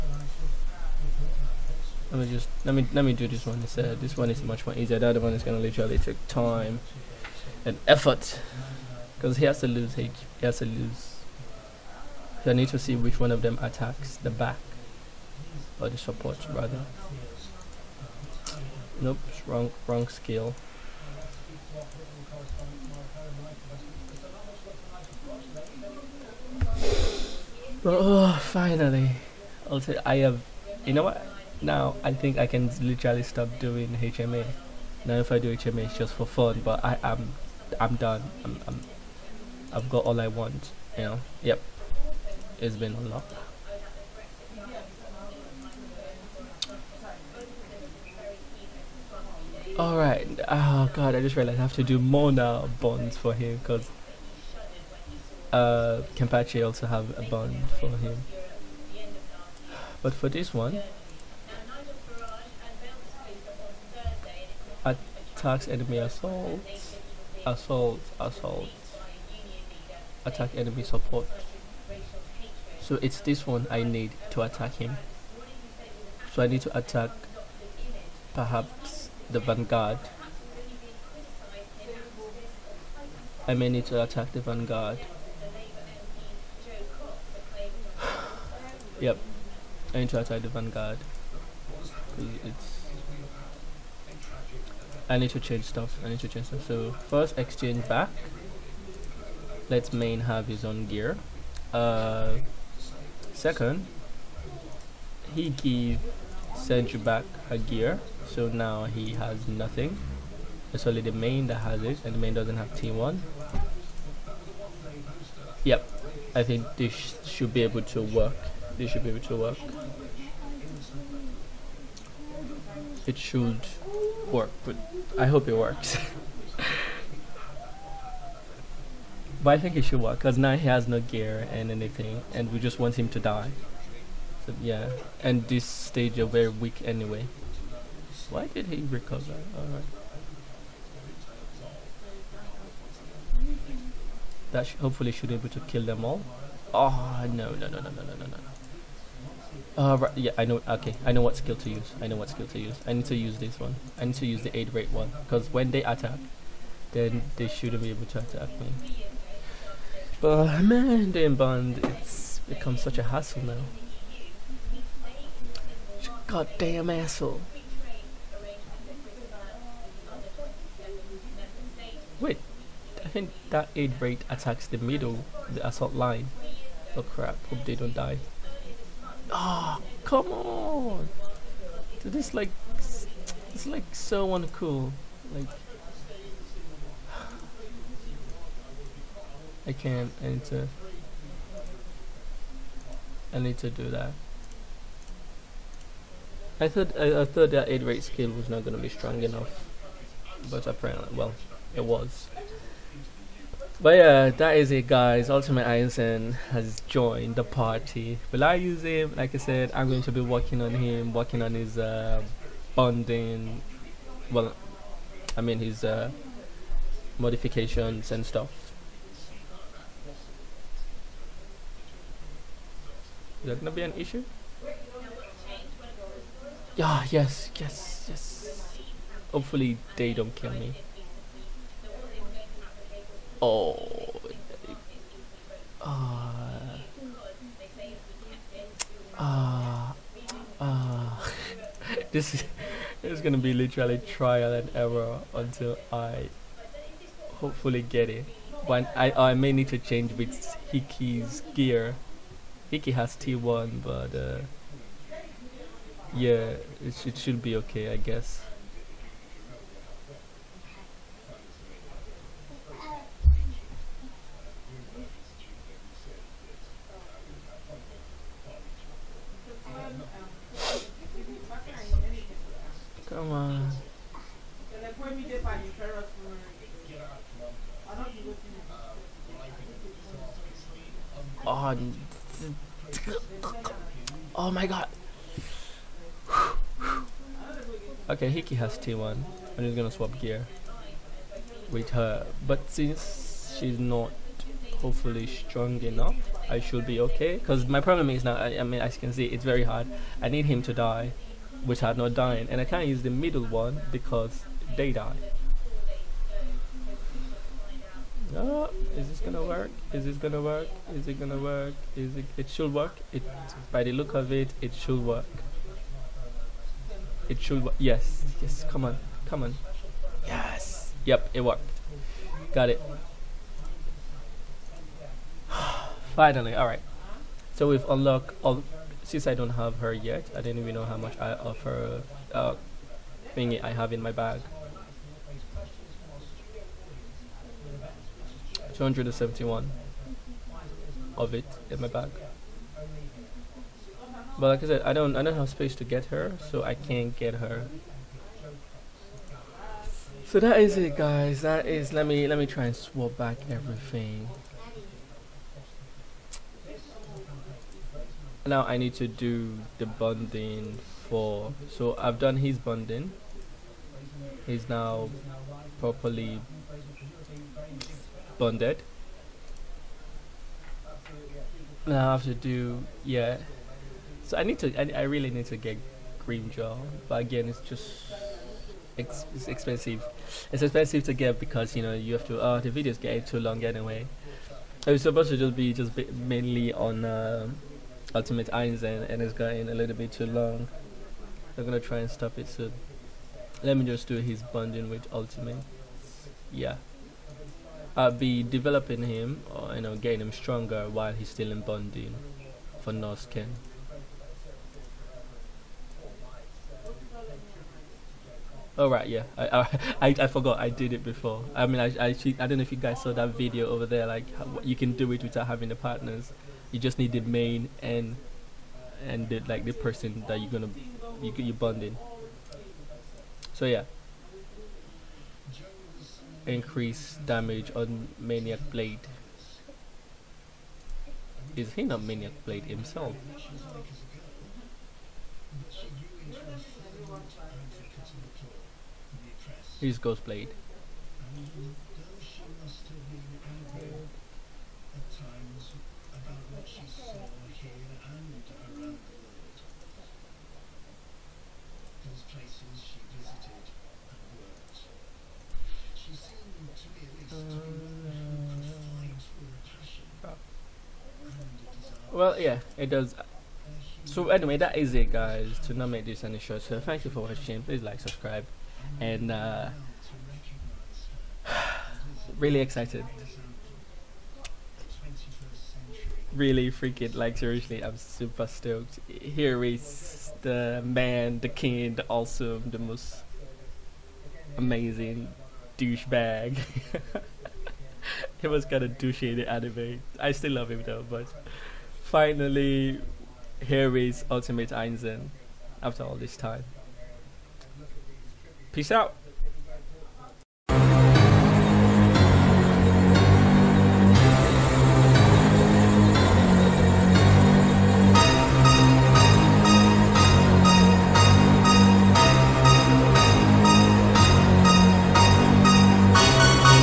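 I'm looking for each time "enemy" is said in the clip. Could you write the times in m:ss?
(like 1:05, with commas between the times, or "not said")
1:05, 1:10.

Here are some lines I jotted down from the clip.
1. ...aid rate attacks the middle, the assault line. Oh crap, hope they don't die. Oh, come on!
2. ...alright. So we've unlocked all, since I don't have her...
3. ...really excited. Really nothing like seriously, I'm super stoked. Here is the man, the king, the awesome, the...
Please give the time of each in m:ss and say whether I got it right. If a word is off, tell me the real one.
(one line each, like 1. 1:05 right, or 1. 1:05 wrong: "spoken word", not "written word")
1. 2:53 right
2. 5:26 right
3. 7:52 wrong: "freaking", not "nothing".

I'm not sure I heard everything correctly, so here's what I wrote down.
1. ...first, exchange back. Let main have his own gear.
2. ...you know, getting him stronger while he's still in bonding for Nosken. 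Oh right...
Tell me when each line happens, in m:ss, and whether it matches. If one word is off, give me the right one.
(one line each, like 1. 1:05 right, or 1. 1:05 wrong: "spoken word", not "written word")
1. 1:37 right
2. 6:39 right.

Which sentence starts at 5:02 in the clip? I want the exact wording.
And I can't use the middle one because they die.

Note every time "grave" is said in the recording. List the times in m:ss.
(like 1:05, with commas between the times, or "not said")
not said.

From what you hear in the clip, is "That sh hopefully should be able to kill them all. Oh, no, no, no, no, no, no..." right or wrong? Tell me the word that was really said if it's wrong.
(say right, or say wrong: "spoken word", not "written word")
right.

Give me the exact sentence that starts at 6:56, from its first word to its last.
You just need the main and and the, like the person that you're gonna you you're bonding.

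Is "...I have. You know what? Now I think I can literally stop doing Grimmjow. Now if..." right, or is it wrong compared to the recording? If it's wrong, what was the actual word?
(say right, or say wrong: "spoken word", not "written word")
wrong: "HMA", not "Grimmjow".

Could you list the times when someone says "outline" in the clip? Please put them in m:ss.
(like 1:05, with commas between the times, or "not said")
not said.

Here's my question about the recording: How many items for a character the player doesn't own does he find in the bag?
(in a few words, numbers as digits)
271.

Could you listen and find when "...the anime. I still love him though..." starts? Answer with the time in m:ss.
8:09.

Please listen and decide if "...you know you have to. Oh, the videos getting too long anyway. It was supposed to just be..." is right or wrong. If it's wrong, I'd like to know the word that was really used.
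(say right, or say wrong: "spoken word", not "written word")
right.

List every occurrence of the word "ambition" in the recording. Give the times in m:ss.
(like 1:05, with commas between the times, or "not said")
not said.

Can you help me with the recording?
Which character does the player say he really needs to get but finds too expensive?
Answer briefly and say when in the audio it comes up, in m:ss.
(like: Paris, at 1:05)
Grimmjow, at 6:16.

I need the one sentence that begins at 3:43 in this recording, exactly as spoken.
Is that gonna be an issue?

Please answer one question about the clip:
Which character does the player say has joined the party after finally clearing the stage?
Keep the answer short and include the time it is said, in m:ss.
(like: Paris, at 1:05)
Ultimate Ironson, at 3:25.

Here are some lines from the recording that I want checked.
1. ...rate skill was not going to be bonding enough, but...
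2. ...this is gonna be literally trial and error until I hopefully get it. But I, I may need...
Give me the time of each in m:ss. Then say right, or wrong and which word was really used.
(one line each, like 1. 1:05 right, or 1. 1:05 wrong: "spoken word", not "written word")
1. 3:17 wrong: "strong", not "bonding"
2. 4:03 right.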